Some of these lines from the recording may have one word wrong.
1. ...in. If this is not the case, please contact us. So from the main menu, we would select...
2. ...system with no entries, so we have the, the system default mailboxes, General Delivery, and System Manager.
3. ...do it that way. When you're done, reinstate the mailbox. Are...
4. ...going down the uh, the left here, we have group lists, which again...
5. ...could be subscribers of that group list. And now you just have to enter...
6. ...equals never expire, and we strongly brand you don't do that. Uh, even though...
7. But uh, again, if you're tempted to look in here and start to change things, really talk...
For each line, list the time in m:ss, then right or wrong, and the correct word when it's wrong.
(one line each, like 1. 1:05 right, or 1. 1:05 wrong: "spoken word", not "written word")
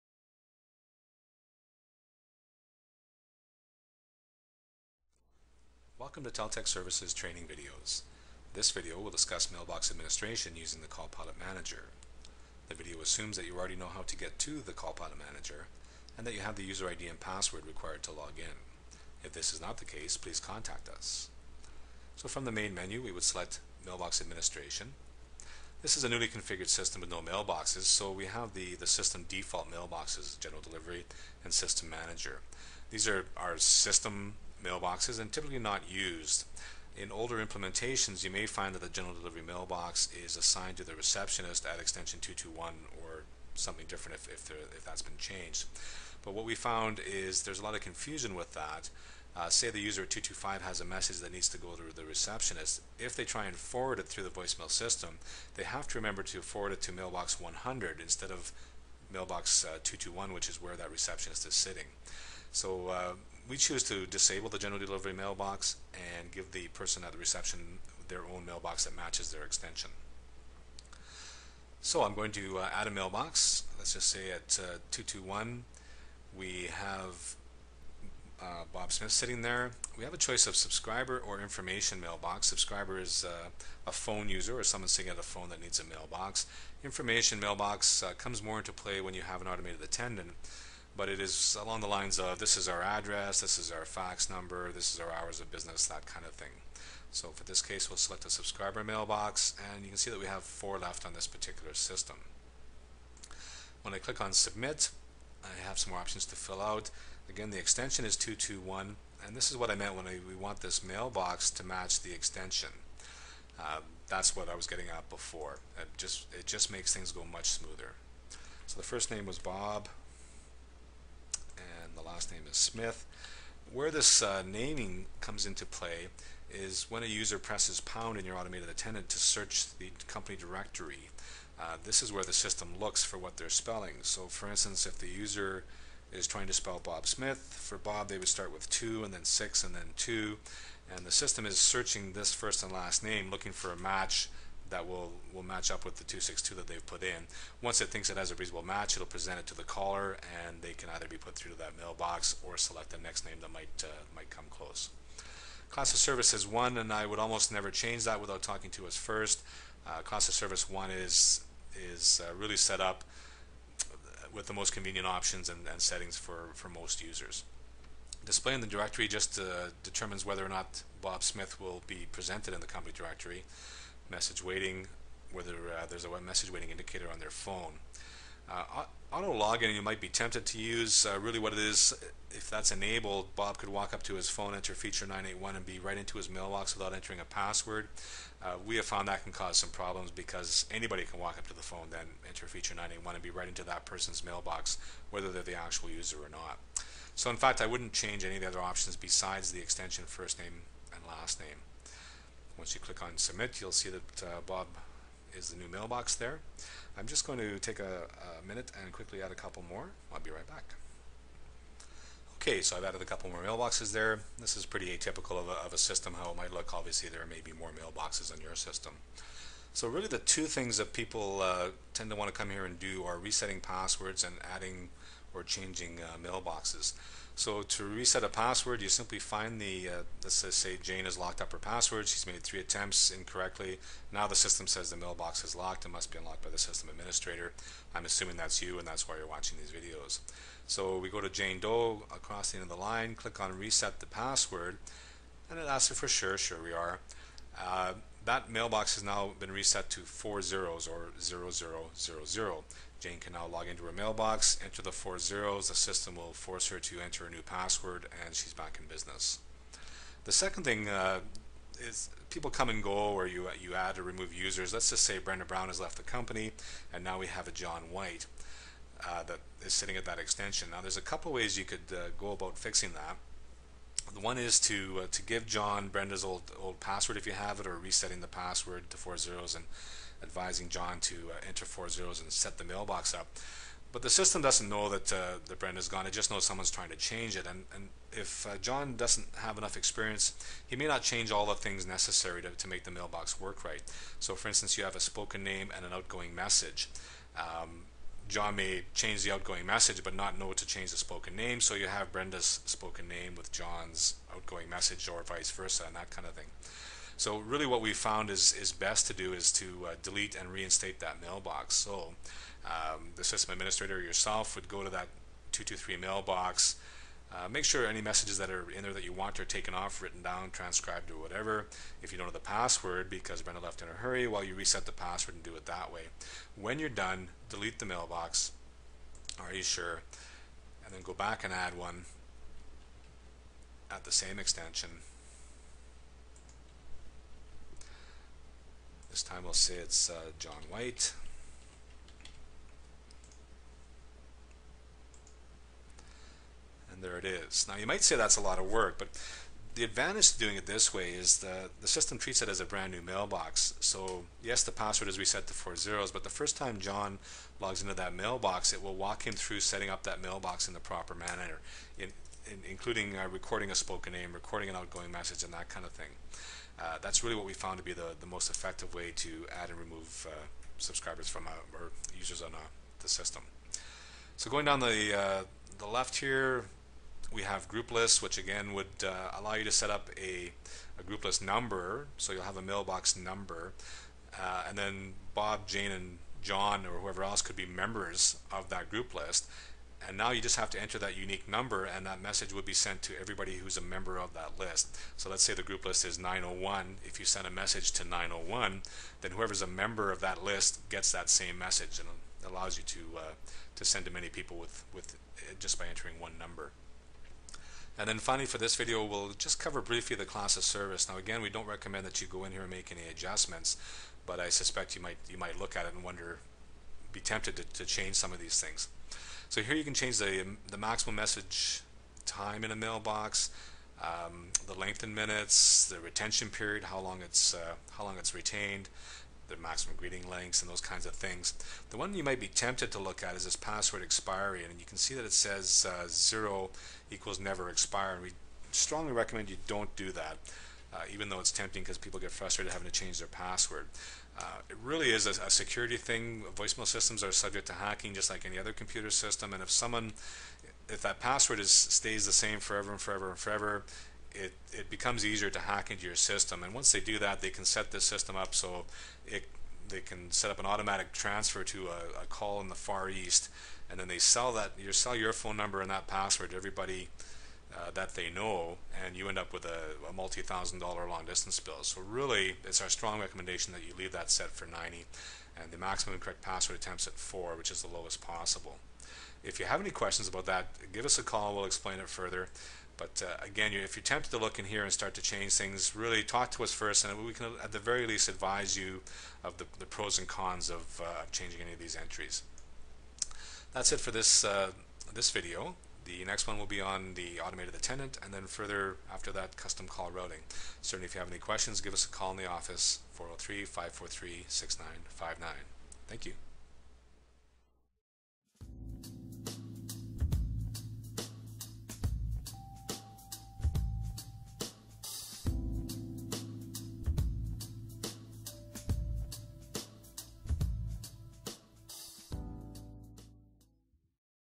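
1. 0:18 right
2. 0:26 wrong: "mailboxes", not "entries"
3. 5:25 wrong: "delete", not "reinstate"
4. 6:14 right
5. 6:27 wrong: "members", not "subscribers"
6. 7:17 wrong: "recommend", not "brand"
7. 8:02 right.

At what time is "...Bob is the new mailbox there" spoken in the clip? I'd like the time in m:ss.
3:24.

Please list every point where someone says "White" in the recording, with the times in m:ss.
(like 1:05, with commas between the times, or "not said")
4:27, 5:40.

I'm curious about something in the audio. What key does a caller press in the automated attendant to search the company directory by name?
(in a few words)
Pound.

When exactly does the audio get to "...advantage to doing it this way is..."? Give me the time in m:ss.
5:49.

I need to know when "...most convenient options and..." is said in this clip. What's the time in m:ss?
2:44.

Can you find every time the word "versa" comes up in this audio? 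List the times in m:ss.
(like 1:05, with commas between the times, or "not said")
5:05.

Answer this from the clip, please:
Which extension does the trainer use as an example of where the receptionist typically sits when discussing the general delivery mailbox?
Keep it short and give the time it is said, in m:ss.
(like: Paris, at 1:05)
221, at 0:41.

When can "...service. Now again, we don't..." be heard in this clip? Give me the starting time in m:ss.
6:50.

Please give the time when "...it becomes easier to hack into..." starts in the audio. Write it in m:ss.
7:34.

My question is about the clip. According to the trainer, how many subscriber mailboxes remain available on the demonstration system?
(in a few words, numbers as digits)
4.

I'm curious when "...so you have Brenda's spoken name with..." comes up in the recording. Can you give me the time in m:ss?
5:01.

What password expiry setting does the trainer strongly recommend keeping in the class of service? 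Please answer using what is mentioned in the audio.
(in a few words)
90.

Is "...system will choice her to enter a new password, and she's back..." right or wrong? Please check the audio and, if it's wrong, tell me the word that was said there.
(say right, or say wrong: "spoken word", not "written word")
wrong: "force", not "choice".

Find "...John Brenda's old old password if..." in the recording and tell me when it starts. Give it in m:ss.
4:35.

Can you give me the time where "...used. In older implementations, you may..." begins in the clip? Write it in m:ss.
0:35.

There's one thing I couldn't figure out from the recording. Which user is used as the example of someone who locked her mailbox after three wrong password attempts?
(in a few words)
Jane Doe.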